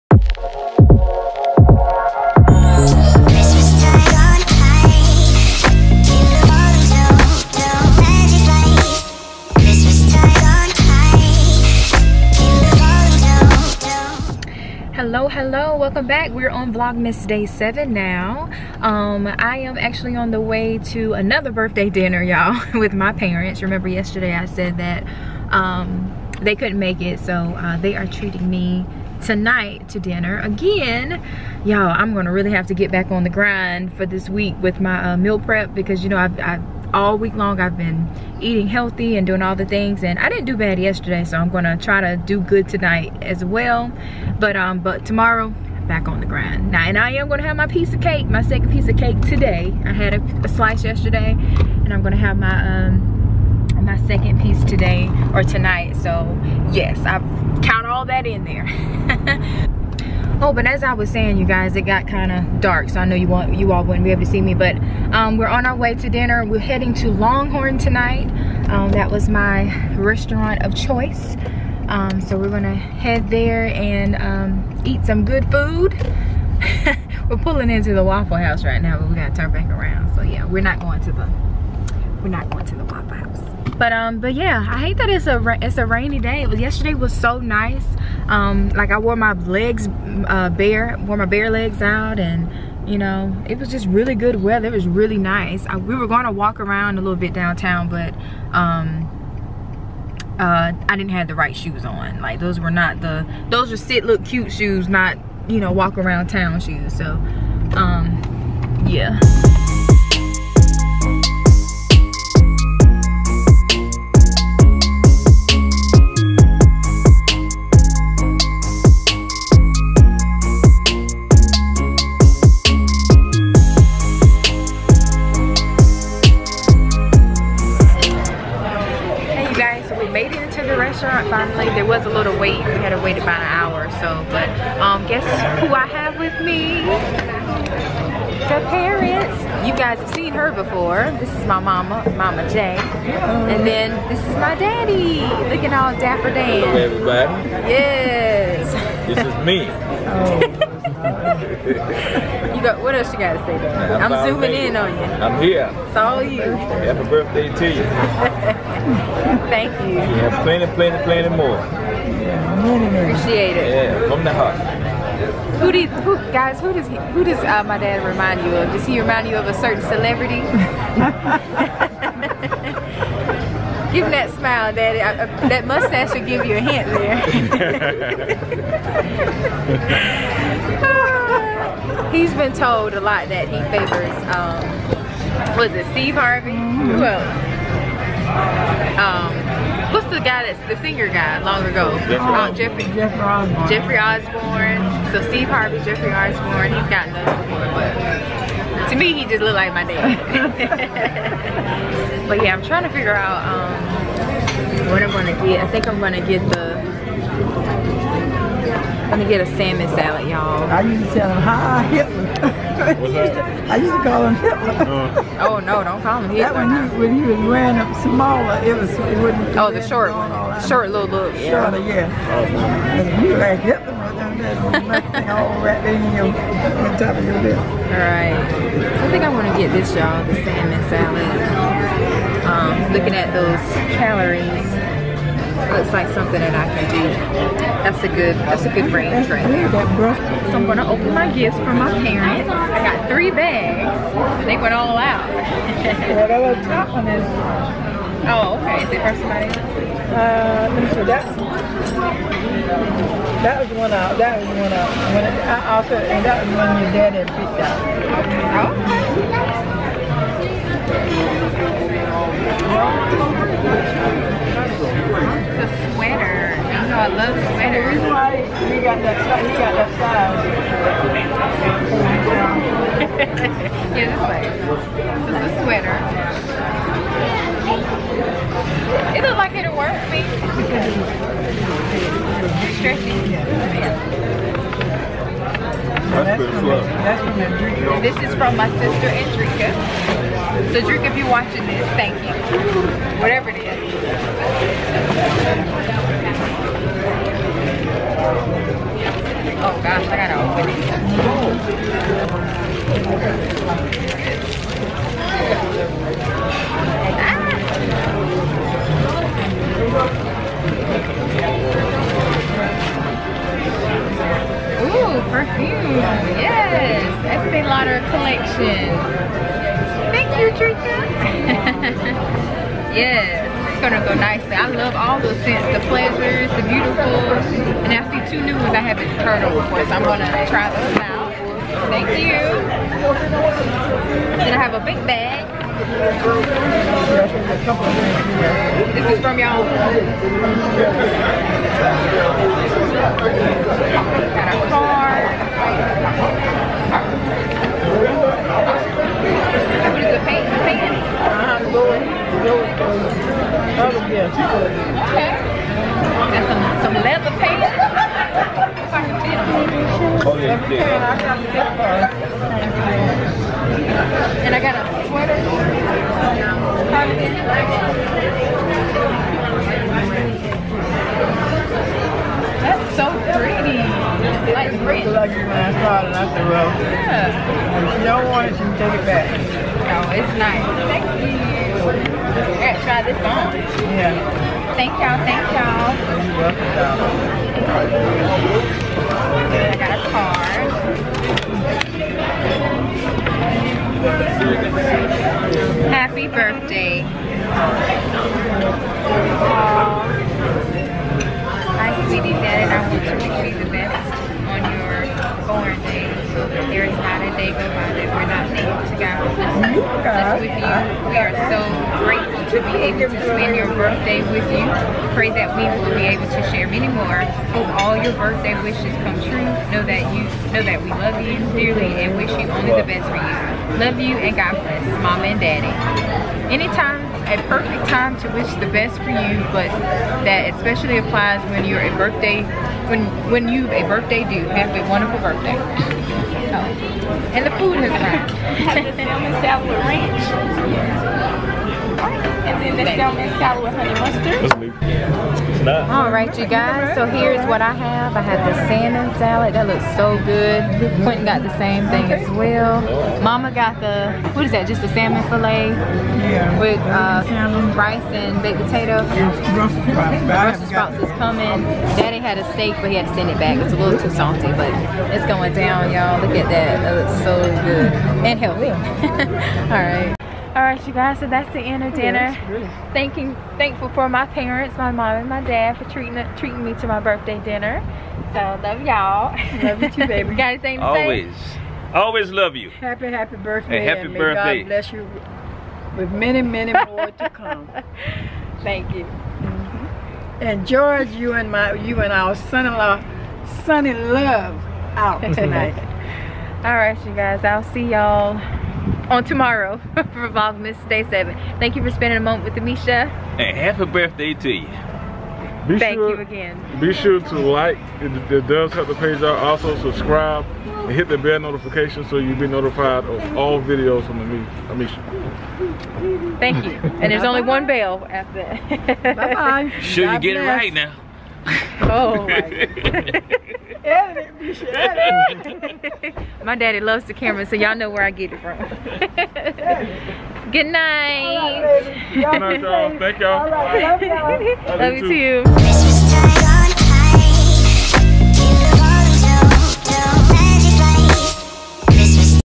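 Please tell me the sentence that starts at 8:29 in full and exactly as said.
Also subscribe and hit the bell notification so you'll be notified of all videos from Amesha.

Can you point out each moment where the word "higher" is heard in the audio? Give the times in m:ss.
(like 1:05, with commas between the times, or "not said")
not said.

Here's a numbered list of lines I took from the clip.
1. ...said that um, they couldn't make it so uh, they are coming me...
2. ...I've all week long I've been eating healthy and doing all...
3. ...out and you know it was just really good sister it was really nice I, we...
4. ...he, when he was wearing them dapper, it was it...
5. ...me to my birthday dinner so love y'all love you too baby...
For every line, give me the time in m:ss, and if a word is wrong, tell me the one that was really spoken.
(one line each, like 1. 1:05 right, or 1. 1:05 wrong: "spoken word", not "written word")
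1. 0:24 wrong: "treating", not "coming"
2. 0:36 right
3. 1:31 wrong: "weather", not "sister"
4. 3:37 wrong: "smaller", not "dapper"
5. 7:56 right.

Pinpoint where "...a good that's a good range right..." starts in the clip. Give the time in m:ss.
3:58.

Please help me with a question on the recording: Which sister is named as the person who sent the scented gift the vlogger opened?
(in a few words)
Andrika.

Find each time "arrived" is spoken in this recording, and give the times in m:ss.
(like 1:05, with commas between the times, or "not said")
7:17.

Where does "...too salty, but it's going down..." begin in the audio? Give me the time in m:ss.
7:43.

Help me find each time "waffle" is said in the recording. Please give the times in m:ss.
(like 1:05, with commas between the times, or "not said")
1:18, 1:22.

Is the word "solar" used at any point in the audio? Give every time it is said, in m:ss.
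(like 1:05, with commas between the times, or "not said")
not said.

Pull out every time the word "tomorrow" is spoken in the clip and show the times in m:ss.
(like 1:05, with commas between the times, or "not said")
0:45, 8:19.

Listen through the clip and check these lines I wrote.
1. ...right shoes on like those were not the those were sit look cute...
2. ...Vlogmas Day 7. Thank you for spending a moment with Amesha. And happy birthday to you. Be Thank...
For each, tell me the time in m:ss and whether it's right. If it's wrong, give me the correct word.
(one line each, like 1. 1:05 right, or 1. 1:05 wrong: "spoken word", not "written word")
1. 1:41 right
2. 8:20 right.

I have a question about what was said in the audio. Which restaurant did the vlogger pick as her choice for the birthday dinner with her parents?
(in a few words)
Longhorn.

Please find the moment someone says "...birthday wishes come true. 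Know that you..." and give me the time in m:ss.
6:58.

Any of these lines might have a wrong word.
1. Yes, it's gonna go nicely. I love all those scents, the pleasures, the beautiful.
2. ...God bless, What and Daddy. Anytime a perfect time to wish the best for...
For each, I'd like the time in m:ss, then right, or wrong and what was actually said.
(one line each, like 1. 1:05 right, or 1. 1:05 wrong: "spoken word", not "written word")
1. 5:22 right
2. 7:04 wrong: "Mama", not "What".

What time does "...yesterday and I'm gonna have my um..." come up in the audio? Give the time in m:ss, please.
0:50.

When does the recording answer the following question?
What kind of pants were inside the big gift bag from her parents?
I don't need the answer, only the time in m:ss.
5:57.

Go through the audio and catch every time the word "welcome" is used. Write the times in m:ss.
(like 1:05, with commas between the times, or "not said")
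0:15, 6:27.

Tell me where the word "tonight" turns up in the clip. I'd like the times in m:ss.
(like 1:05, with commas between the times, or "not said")
0:29, 0:42, 0:55, 1:07, 8:15.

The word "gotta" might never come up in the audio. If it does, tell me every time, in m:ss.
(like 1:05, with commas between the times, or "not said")
1:19, 2:33, 5:03.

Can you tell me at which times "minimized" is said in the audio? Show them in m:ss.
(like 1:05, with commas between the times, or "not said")
not said.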